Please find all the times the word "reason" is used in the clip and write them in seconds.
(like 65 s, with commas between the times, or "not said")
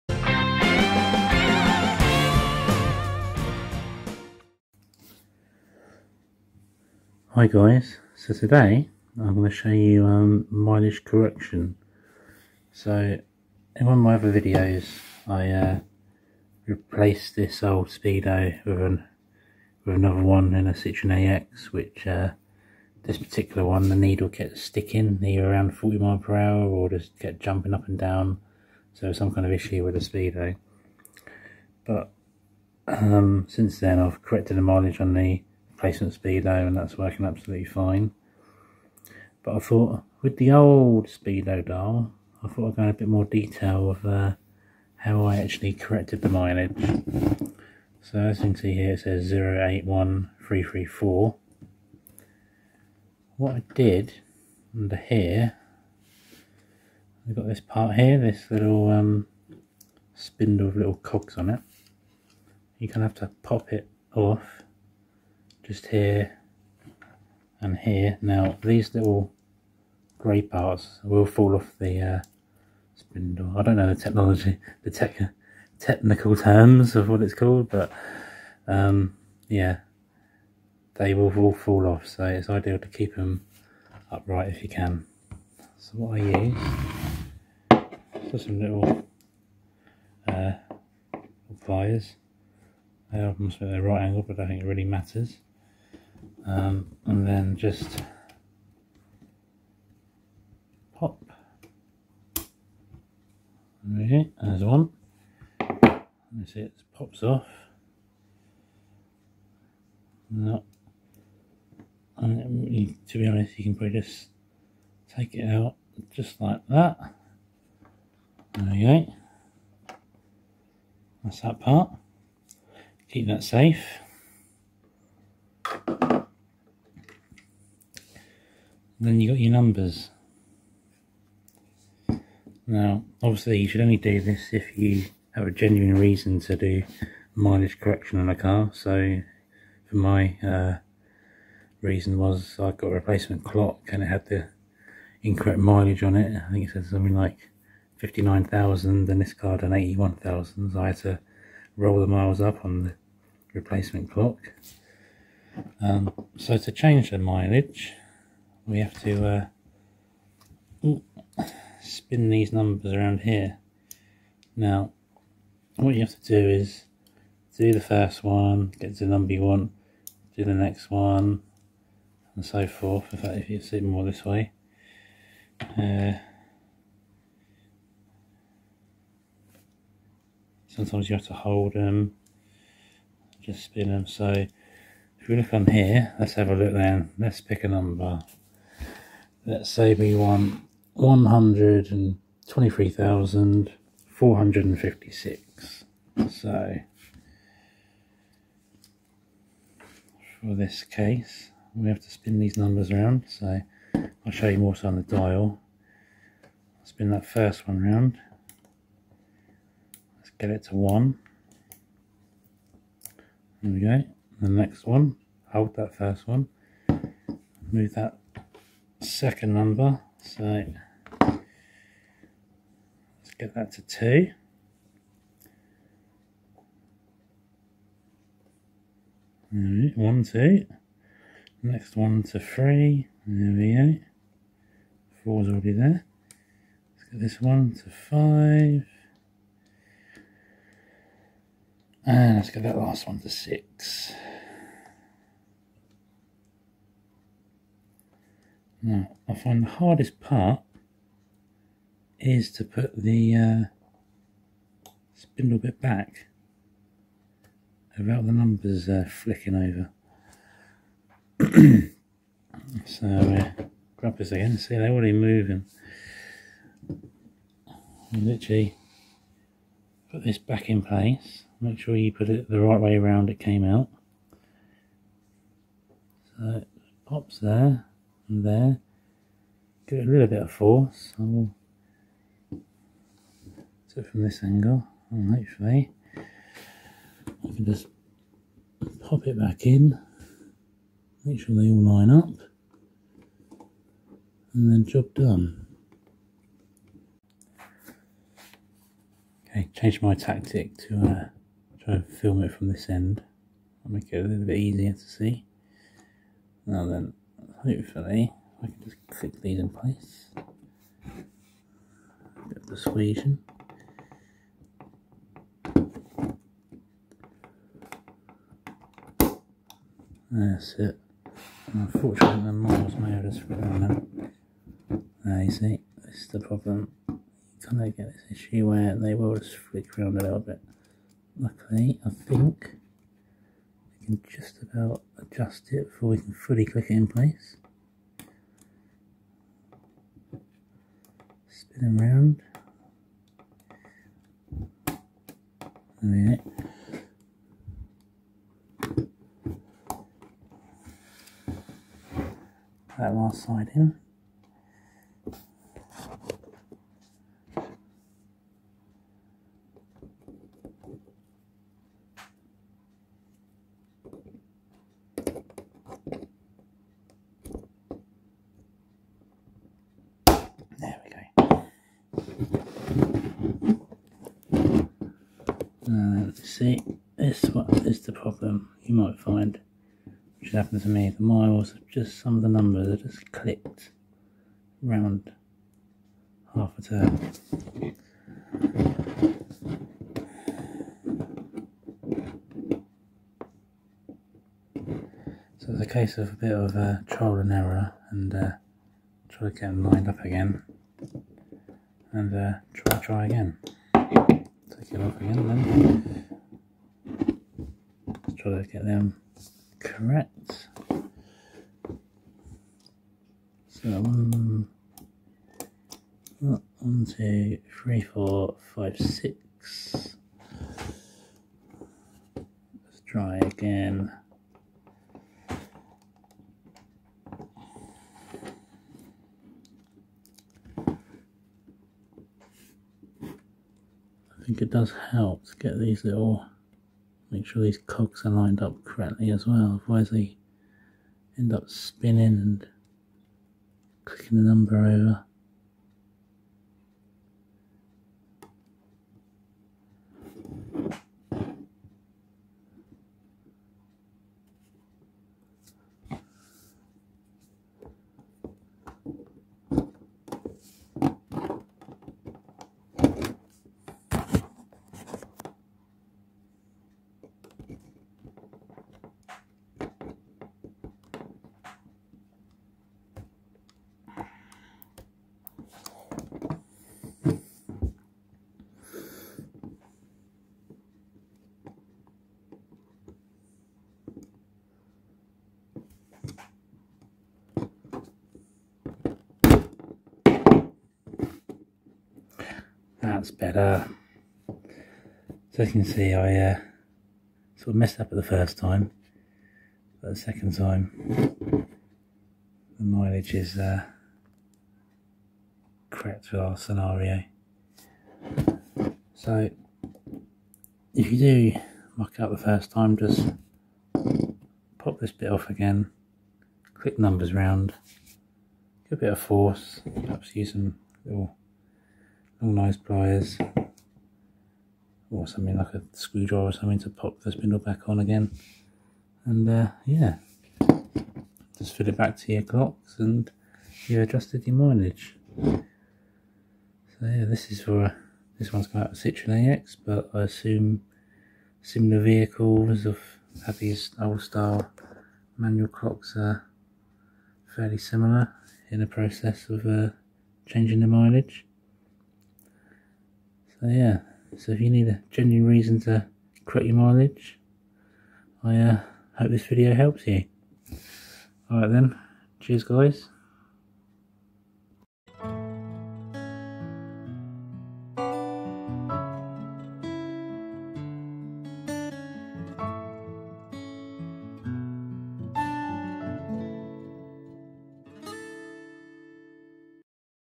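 135 s, 141 s, 555 s.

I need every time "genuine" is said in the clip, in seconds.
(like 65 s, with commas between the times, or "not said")
135 s, 555 s.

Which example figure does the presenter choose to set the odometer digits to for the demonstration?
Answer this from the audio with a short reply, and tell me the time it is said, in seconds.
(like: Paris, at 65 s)
123,456, at 190 s.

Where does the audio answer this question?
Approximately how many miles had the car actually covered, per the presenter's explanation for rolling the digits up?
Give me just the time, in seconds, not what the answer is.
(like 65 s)
149 s.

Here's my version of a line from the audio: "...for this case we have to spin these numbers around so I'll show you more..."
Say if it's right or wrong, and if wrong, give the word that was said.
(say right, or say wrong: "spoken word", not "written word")
right.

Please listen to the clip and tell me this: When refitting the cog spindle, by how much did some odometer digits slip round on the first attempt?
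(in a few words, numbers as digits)
half a turn.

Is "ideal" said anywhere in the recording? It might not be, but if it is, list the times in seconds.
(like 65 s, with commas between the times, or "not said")
82 s.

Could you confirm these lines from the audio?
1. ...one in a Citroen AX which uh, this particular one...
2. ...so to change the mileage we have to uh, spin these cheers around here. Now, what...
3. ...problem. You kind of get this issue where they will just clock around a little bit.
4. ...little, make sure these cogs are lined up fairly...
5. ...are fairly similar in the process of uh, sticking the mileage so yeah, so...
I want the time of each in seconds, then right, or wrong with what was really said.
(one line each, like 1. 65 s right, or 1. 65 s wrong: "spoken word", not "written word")
1. 20 s right
2. 156 s wrong: "numbers", not "cheers"
3. 326 s wrong: "flick", not "clock"
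4. 436 s wrong: "correctly", not "fairly"
5. 546 s wrong: "changing", not "sticking".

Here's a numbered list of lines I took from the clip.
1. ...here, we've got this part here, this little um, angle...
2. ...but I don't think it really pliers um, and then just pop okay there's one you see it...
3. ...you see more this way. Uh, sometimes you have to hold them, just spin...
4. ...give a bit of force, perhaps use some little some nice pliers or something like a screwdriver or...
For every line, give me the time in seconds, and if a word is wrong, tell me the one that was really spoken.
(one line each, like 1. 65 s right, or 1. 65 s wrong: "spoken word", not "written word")
1. 54 s wrong: "spindle", not "angle"
2. 94 s wrong: "matters", not "pliers"
3. 173 s right
4. 518 s right.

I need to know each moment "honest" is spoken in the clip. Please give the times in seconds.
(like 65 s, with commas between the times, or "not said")
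113 s.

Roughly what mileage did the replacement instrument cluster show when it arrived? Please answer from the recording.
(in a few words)
59,000.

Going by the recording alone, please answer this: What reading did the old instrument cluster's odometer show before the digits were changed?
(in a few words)
081334.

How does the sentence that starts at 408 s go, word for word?
Let's try to get them correct.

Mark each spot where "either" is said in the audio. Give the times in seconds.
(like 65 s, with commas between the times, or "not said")
25 s.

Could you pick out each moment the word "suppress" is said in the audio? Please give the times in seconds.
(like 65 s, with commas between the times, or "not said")
not said.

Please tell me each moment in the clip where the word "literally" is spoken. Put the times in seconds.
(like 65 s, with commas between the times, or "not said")
268 s.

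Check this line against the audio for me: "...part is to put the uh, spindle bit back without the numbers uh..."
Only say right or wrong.
right.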